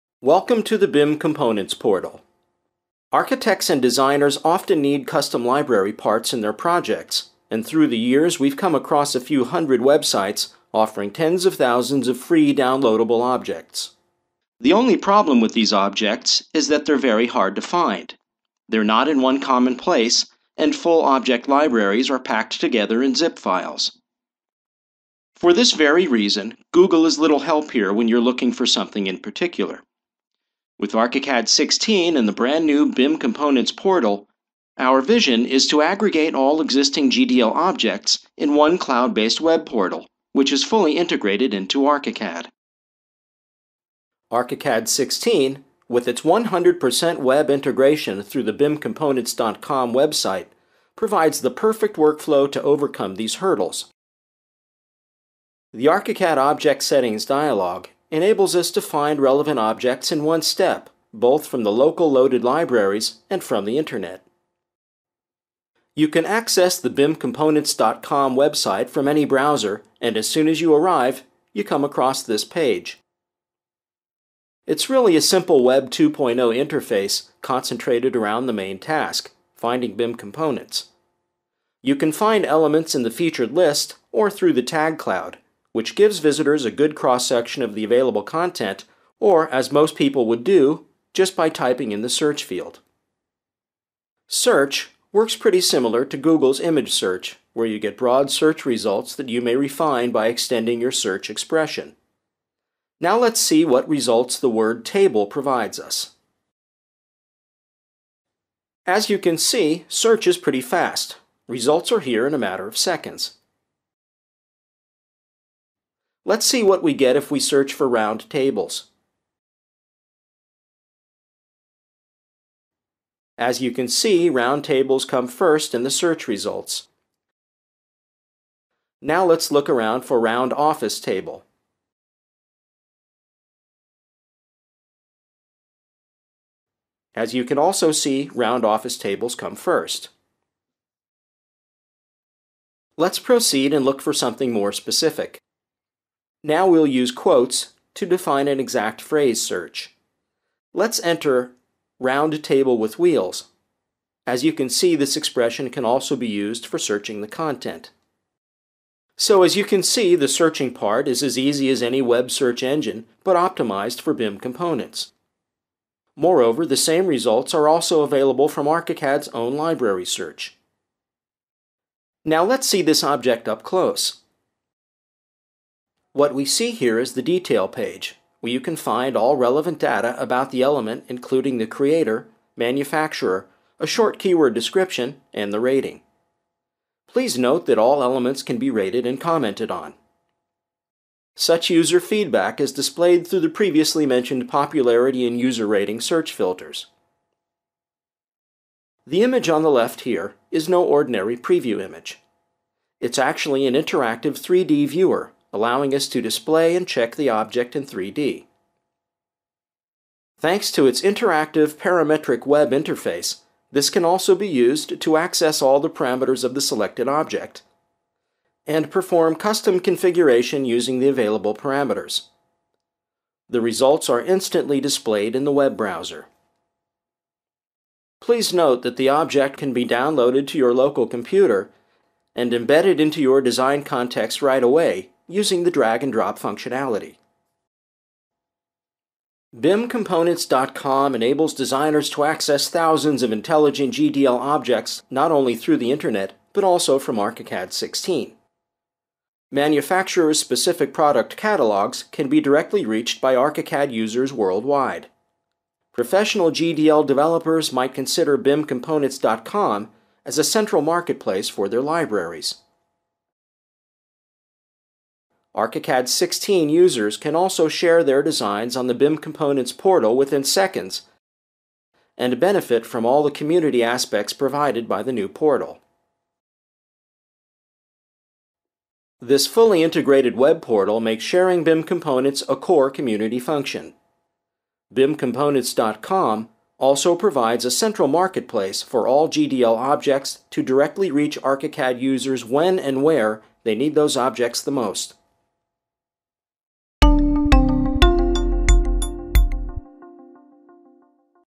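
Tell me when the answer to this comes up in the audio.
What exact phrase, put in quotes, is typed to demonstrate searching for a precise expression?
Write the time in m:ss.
2:31.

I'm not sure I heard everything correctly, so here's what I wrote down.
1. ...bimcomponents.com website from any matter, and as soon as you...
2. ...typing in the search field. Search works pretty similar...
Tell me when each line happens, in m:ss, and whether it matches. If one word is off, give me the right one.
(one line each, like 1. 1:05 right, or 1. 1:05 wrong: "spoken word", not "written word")
1. 1:06 wrong: "browser", not "matter"
2. 1:31 right.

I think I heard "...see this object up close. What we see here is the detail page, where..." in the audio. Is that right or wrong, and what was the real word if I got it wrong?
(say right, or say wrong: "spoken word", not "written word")
right.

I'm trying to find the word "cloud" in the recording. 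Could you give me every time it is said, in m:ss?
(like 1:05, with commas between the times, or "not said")
0:38, 1:24.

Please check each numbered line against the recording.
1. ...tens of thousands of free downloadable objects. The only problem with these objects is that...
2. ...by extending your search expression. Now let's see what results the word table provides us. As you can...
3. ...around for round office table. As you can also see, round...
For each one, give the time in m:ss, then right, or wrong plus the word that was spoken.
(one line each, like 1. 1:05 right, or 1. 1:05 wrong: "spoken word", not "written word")
1. 0:11 right
2. 1:40 right
3. 2:09 right.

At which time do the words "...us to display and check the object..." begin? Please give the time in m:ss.
3:25.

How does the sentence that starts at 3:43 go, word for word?
The results are instantly displayed in the web browser.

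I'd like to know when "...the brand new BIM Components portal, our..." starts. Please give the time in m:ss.
0:32.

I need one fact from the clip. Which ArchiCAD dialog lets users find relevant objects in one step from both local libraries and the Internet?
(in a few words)
Object Settings.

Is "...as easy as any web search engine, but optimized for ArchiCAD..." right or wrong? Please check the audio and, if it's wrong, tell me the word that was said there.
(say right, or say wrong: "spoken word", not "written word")
wrong: "BIM", not "ArchiCAD".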